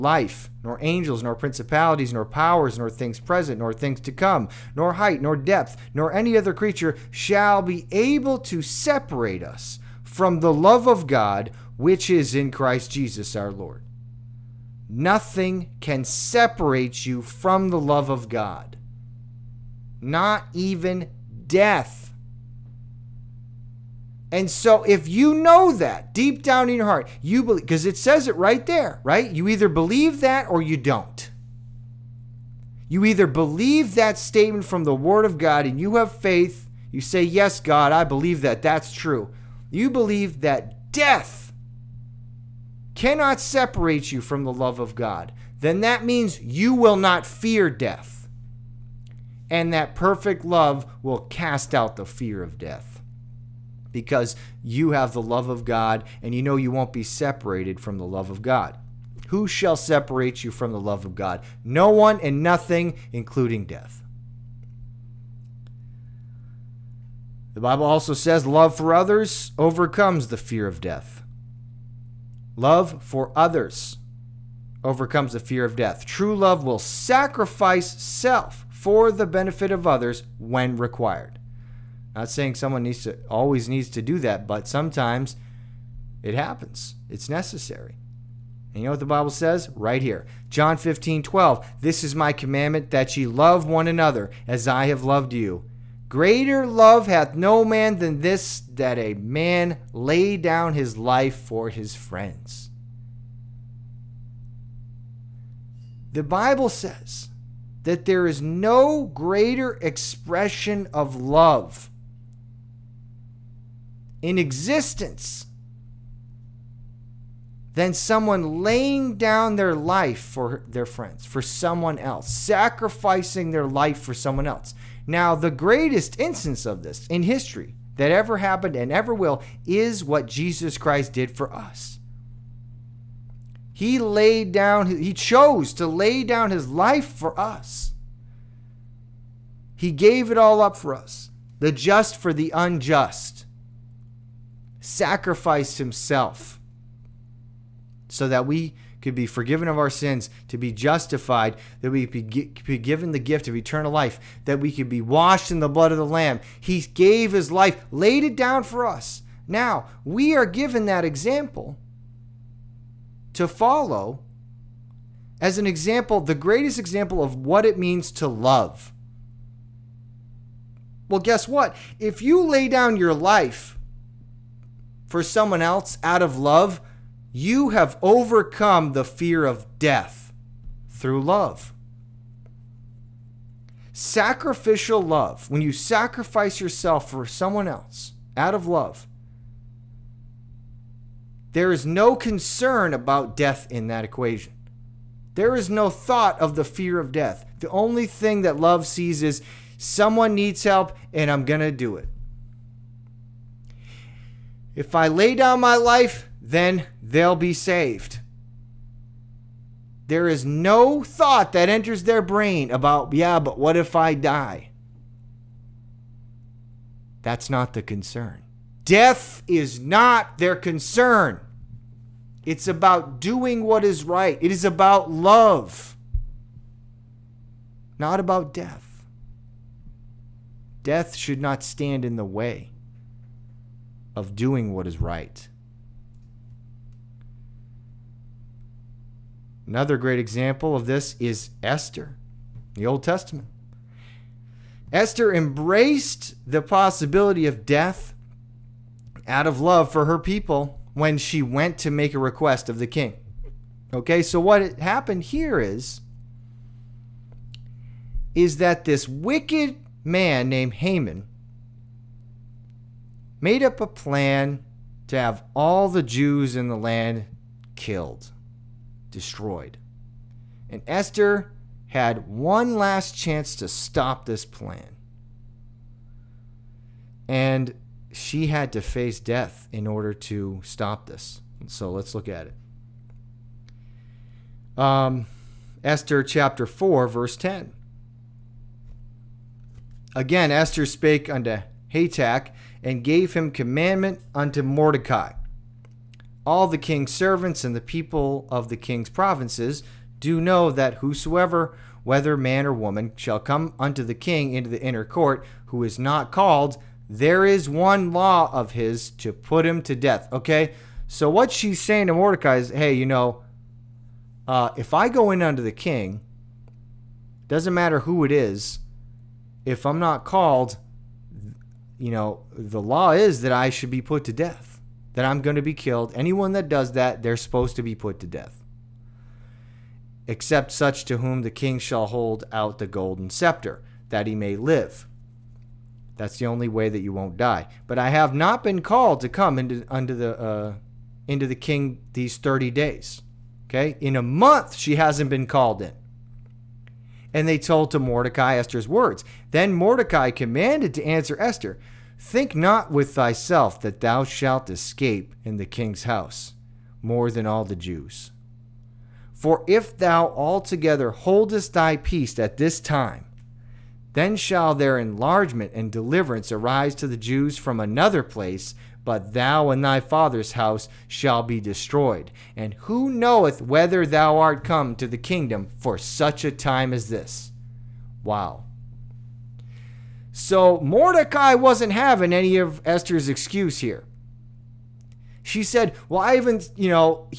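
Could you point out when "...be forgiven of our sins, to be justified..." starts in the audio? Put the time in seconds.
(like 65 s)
149 s.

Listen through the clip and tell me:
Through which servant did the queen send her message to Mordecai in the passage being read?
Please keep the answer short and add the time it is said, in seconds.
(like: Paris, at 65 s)
Hatach, at 291 s.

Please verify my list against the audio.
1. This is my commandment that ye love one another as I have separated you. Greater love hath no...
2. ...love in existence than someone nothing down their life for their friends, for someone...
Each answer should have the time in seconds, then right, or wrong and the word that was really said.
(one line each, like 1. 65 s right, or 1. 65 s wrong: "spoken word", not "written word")
1. 91 s wrong: "loved", not "separated"
2. 111 s wrong: "laying", not "nothing".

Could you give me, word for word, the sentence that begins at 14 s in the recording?
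Nothing can separate you from the love of God, not even death.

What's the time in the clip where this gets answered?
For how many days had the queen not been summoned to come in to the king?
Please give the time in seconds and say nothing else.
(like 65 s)
342 s.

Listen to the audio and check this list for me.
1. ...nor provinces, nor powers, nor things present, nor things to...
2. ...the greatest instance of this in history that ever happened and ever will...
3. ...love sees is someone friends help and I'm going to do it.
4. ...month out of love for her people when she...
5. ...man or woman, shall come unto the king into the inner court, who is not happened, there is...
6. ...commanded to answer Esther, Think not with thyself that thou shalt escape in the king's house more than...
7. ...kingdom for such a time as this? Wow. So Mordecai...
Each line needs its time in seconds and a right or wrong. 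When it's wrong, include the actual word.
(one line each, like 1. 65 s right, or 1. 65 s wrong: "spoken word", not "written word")
1. 1 s wrong: "principalities", not "provinces"
2. 125 s right
3. 198 s wrong: "needs", not "friends"
4. 247 s wrong: "death", not "month"
5. 302 s wrong: "called", not "happened"
6. 350 s right
7. 375 s right.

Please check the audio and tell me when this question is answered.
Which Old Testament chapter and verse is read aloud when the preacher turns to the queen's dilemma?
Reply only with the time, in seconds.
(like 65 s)
285 s.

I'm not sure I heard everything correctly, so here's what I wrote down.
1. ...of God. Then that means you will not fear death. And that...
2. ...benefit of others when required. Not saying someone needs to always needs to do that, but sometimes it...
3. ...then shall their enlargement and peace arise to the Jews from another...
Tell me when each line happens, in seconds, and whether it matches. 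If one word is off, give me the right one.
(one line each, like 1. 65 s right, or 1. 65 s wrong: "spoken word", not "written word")
1. 44 s right
2. 79 s right
3. 364 s wrong: "deliverance", not "peace".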